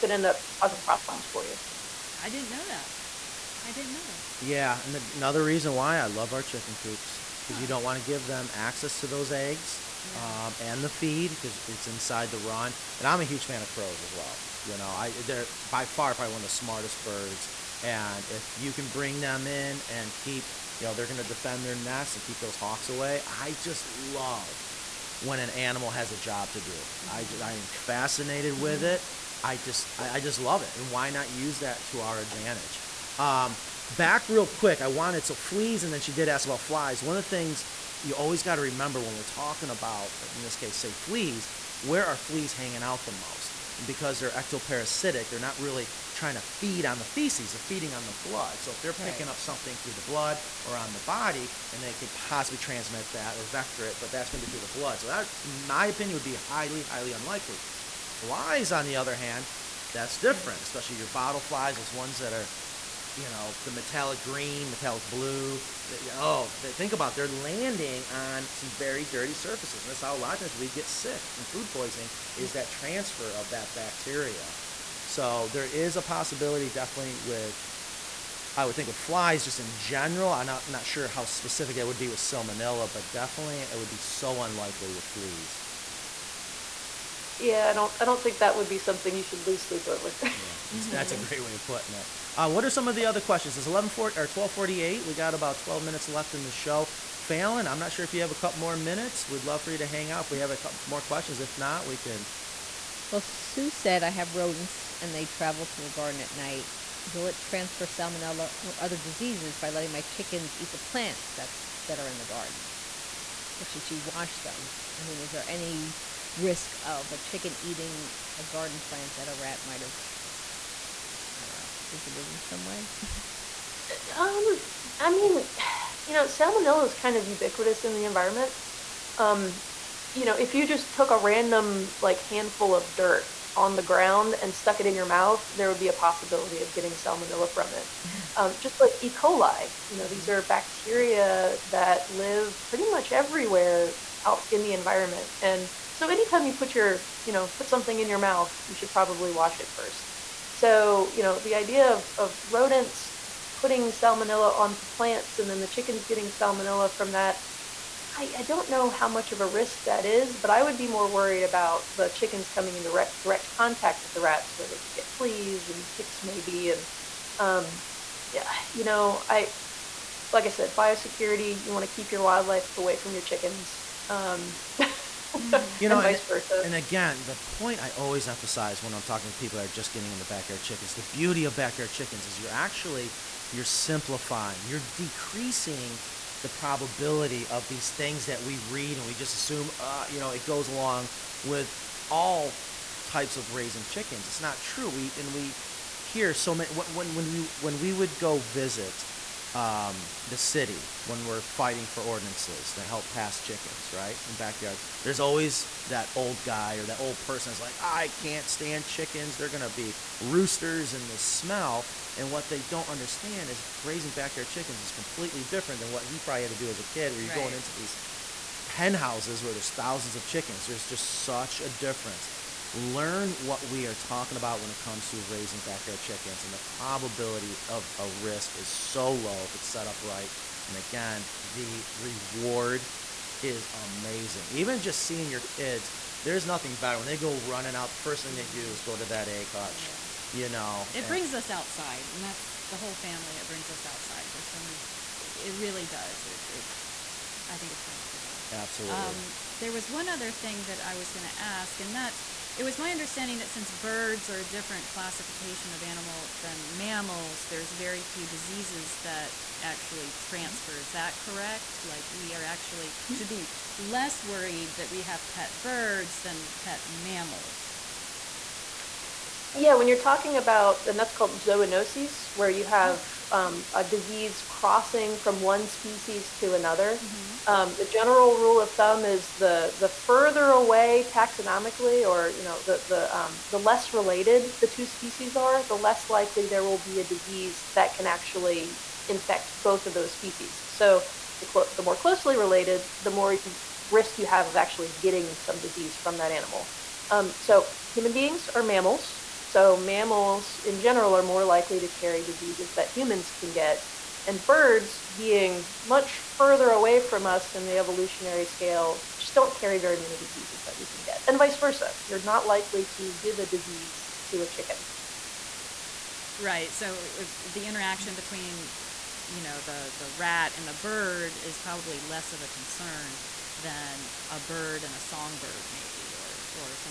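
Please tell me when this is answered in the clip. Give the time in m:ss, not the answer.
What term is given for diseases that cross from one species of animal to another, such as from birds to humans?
4:31.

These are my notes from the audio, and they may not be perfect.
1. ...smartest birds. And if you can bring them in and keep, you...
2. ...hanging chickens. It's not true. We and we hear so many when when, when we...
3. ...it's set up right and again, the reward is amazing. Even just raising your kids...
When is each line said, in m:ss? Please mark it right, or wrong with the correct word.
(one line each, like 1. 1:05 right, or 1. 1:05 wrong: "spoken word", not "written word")
1. 0:16 right
2. 3:13 wrong: "raising", not "hanging"
3. 3:49 wrong: "seeing", not "raising".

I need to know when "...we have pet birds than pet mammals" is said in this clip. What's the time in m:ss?
4:24.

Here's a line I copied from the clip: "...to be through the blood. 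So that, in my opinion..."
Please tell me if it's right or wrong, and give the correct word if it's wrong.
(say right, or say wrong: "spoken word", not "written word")
right.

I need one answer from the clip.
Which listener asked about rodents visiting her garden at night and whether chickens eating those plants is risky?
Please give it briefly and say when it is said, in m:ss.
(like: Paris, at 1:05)
Sue, at 1:43.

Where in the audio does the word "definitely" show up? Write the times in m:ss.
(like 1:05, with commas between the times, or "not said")
1:16, 1:23.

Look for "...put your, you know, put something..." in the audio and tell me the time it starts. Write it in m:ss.
2:26.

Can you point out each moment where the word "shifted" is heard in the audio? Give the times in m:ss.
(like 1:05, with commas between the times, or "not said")
not said.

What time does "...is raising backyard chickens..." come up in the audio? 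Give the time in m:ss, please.
3:33.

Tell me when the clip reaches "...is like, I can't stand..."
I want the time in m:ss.
3:27.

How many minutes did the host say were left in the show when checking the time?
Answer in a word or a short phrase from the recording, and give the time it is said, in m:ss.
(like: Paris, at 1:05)
12, at 1:35.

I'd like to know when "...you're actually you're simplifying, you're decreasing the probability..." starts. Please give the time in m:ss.
3:02.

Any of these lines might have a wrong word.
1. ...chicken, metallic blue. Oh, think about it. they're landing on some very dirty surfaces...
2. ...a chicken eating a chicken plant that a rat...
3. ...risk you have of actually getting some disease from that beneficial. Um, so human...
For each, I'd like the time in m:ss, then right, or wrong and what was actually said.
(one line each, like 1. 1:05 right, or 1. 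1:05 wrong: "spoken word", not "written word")
1. 1:04 wrong: "green", not "chicken"
2. 1:57 wrong: "garden", not "chicken"
3. 4:53 wrong: "animal", not "beneficial".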